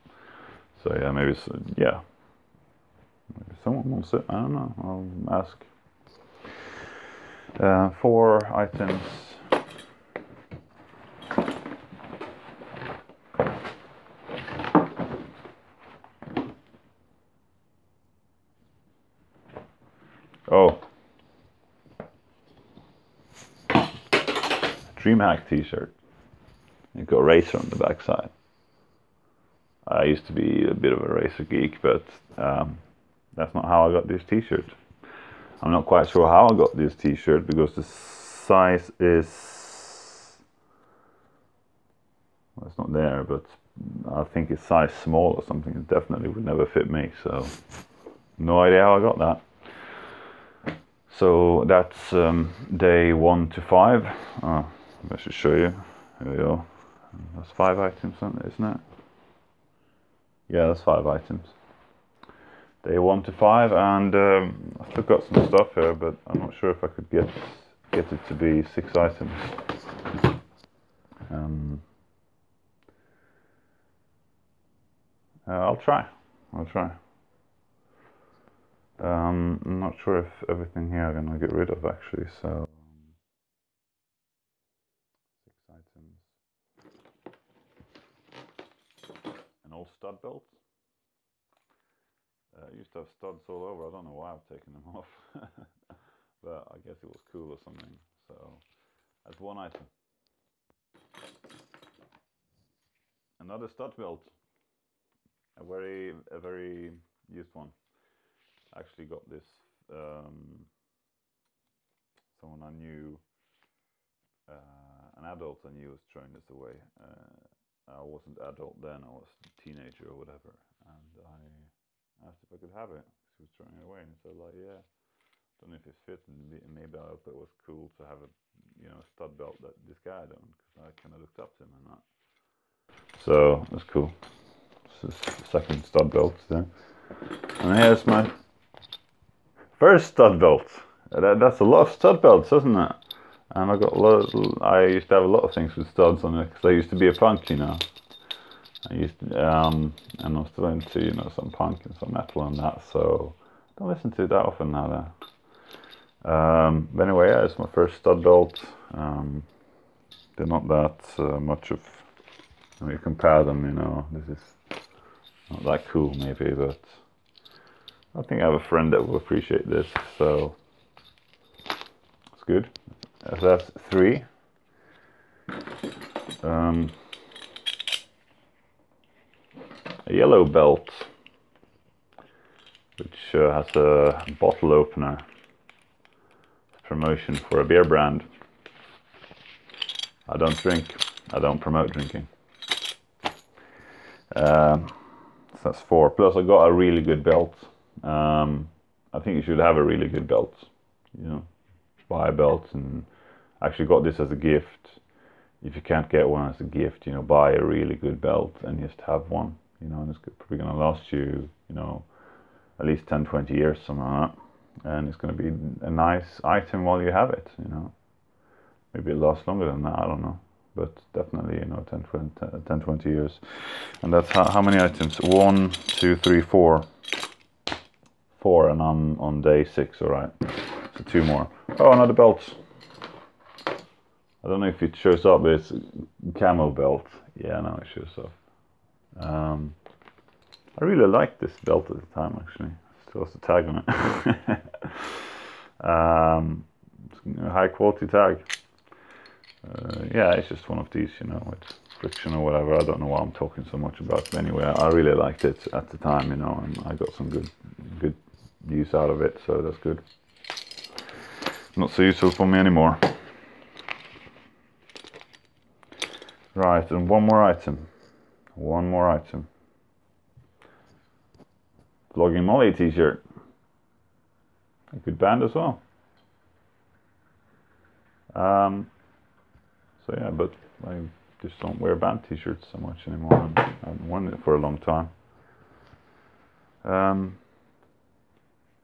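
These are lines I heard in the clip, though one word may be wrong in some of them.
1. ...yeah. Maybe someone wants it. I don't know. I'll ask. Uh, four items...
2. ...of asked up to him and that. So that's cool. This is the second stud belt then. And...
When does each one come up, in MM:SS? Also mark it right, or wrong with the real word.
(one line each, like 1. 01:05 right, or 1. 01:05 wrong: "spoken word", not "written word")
1. 00:01 right
2. 02:11 wrong: "looked", not "asked".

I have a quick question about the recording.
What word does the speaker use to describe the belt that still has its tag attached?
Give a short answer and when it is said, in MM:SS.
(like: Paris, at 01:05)
Camel, at 03:56.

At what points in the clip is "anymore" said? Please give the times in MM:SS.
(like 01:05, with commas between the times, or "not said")
04:22, 04:43.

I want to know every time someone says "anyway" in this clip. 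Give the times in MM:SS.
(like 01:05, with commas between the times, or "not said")
02:37, 04:14.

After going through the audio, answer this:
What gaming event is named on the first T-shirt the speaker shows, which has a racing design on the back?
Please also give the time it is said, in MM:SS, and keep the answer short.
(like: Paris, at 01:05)
DreamHack, at 00:25.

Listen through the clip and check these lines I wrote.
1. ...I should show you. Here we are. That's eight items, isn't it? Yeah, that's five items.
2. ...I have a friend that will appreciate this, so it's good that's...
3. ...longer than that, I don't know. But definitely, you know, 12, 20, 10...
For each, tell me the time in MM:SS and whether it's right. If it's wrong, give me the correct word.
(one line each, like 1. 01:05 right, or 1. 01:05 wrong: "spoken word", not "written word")
1. 00:55 wrong: "five", not "eight"
2. 02:48 right
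3. 03:39 wrong: "10", not "12".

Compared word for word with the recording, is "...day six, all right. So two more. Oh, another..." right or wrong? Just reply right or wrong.
right.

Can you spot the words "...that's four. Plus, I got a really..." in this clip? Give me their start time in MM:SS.
03:15.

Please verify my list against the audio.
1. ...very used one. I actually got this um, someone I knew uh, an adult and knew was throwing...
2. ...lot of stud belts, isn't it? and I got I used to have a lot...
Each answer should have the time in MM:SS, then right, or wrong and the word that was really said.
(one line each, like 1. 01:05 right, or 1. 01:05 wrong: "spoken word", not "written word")
1. 01:46 right
2. 02:21 right.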